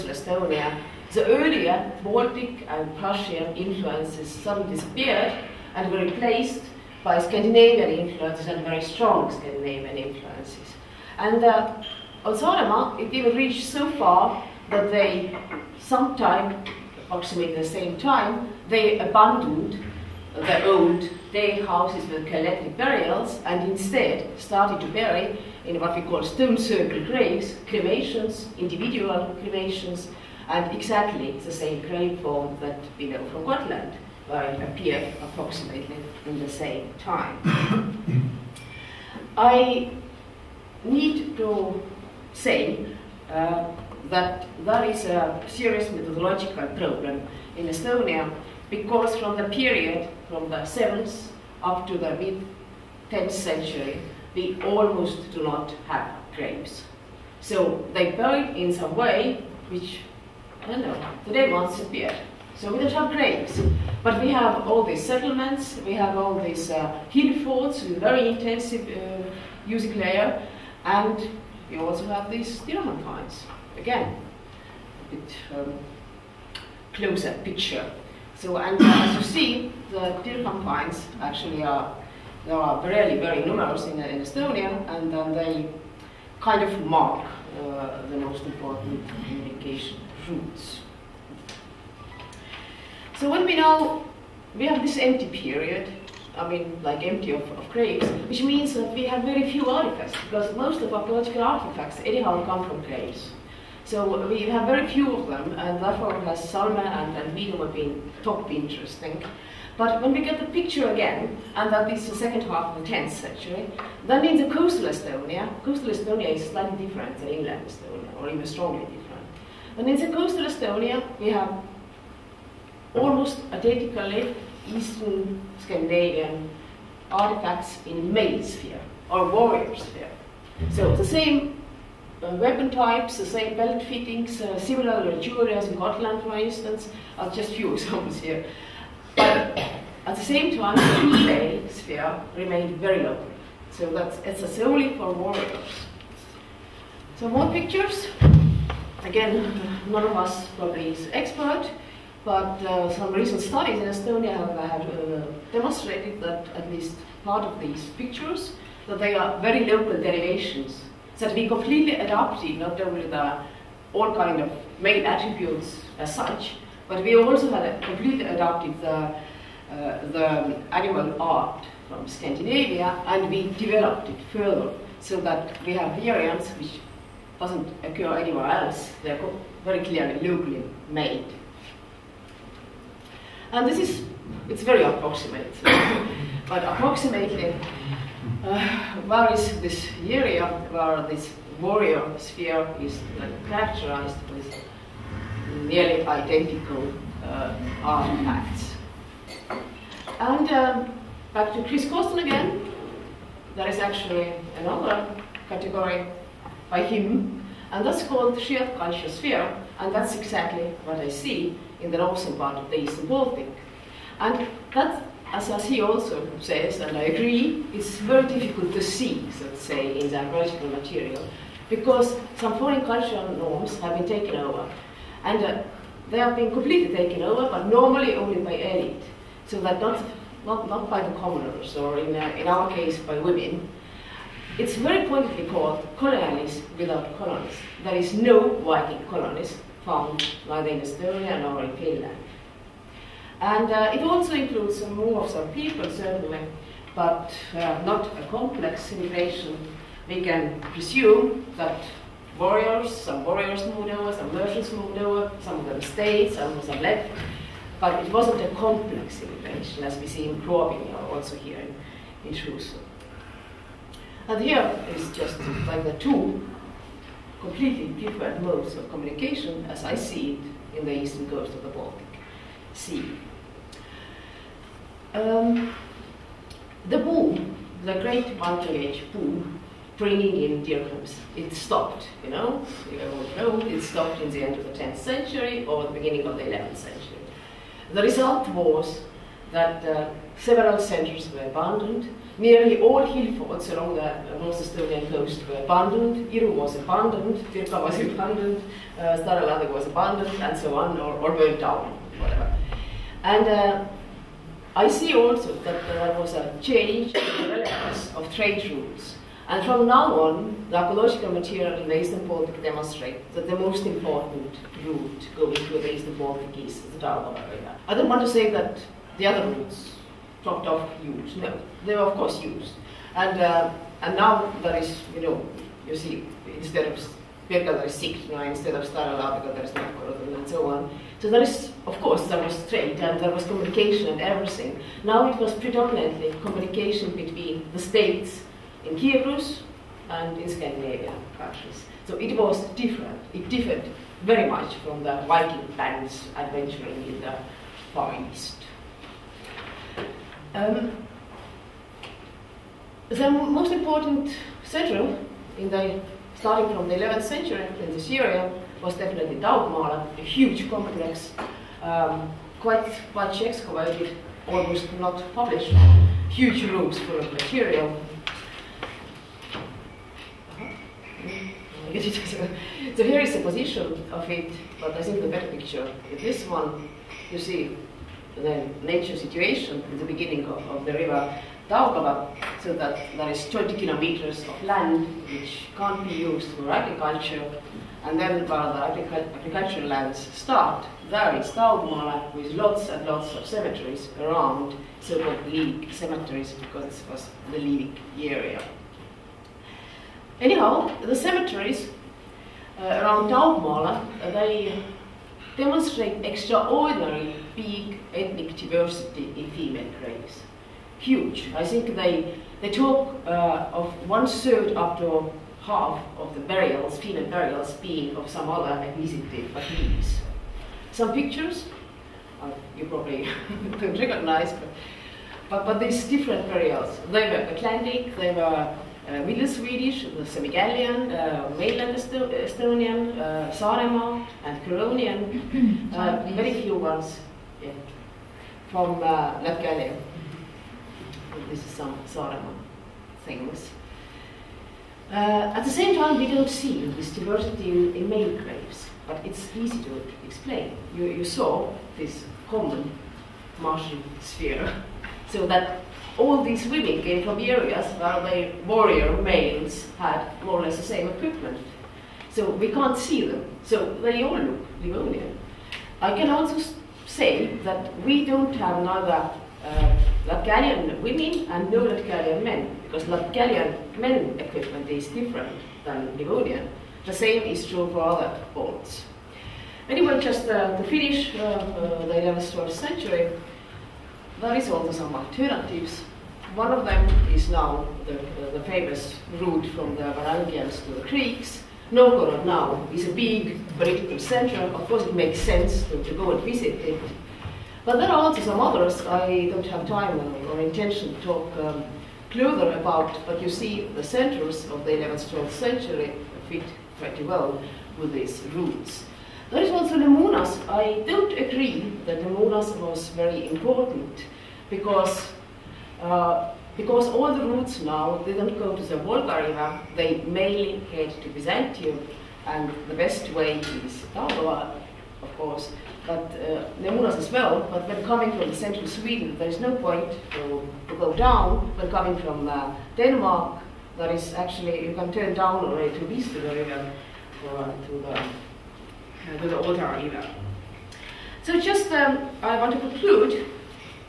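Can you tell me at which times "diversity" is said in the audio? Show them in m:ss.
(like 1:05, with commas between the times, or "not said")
6:48, 7:27.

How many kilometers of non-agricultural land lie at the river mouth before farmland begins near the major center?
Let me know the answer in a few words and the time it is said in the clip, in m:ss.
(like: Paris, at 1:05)
20, at 6:23.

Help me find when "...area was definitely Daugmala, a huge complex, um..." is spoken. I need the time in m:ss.
5:58.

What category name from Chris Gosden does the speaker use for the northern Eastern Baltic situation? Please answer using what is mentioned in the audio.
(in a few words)
shared conscious sphere.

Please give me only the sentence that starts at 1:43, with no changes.
So we have very few of them, and therefore has Salme and, and Vidoma been top interesting.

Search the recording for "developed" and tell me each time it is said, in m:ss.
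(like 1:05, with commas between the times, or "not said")
2:53.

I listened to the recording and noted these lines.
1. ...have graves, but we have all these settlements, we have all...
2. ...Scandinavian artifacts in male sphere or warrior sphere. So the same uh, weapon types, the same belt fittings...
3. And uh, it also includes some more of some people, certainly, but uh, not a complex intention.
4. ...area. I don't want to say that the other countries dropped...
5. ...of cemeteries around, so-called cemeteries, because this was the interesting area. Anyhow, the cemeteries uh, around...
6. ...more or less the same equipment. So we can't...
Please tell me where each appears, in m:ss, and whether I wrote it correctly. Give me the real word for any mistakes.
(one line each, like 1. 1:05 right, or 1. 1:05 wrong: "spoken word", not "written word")
1. 1:02 right
2. 2:05 right
3. 4:03 wrong: "immigration", not "intention"
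4. 5:17 wrong: "routes", not "countries"
5. 6:33 wrong: "living", not "interesting"
6. 7:40 right.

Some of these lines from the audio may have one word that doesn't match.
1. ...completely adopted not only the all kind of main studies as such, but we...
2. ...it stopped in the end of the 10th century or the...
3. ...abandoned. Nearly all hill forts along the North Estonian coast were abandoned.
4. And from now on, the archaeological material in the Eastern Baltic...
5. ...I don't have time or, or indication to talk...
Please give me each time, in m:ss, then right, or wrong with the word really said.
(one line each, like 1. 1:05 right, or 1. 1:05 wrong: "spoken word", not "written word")
1. 2:41 wrong: "attributes", not "studies"
2. 4:43 right
3. 4:51 right
4. 5:09 right
5. 8:19 wrong: "intention", not "indication".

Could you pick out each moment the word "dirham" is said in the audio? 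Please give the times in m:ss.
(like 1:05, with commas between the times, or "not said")
1:12, 1:20, 4:40.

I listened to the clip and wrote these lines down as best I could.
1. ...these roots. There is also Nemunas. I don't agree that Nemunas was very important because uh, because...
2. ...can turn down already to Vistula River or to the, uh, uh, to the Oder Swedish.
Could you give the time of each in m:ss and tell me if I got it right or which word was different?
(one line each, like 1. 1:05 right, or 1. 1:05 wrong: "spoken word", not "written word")
1. 8:28 right
2. 8:54 wrong: "River", not "Swedish".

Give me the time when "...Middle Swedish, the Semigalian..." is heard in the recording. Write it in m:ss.
7:09.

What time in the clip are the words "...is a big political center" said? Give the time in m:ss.
8:12.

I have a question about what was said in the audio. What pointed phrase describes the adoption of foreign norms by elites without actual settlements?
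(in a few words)
colonies without colonies.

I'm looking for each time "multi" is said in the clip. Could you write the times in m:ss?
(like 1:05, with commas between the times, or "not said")
4:38.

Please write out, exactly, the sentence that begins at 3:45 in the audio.
And uh, they have been completely taken over, but normally only by elite.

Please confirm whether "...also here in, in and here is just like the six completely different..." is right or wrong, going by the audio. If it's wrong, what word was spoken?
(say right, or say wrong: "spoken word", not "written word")
wrong: "two", not "six".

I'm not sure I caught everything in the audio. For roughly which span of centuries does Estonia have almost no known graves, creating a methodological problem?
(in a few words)
7th to mid 10th century.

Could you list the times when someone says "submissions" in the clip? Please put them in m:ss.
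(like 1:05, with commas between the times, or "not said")
not said.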